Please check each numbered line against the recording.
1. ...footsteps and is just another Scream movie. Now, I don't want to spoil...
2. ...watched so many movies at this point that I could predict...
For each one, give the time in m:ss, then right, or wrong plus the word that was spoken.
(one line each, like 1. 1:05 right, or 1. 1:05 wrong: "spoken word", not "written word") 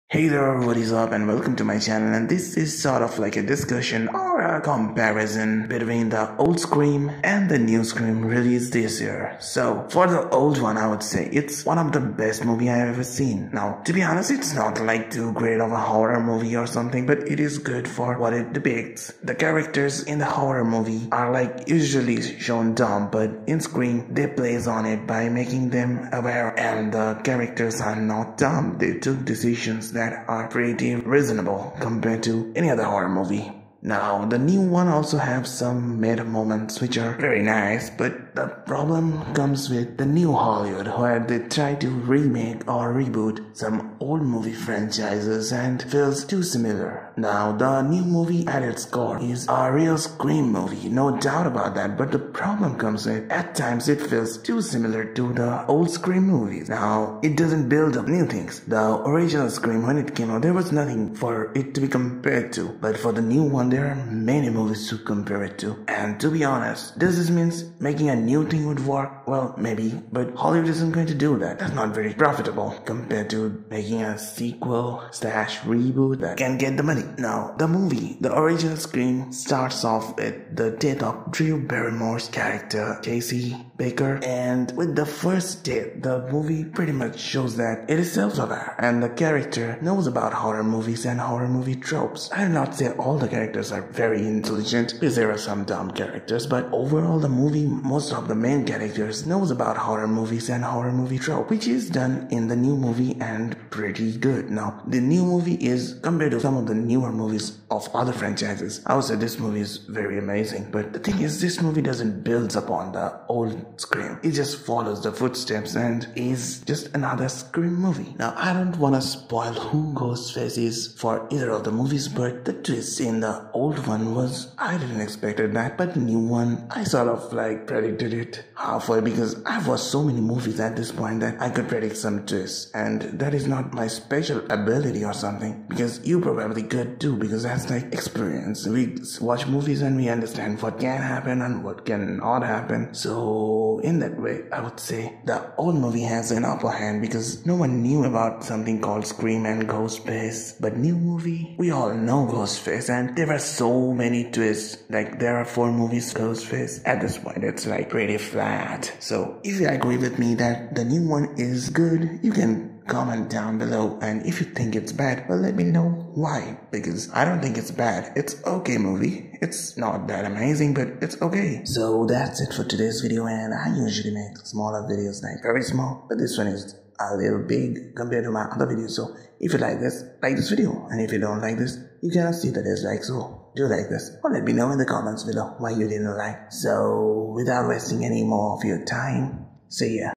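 1. 1:55 right
2. 2:09 right.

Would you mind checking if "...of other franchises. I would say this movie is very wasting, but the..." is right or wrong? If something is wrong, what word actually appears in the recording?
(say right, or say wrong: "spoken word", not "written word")
wrong: "amazing", not "wasting".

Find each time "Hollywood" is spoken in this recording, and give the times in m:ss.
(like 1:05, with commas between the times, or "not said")
0:40, 1:10.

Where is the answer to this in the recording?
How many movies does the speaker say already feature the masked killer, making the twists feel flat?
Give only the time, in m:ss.
2:35.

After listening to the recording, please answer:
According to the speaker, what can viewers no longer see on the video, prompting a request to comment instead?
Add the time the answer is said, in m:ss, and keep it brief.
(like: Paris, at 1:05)
the dislikes, at 3:02.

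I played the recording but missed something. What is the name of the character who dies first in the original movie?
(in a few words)
Casey Baker.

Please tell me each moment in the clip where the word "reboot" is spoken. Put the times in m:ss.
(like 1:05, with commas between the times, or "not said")
0:42, 1:15.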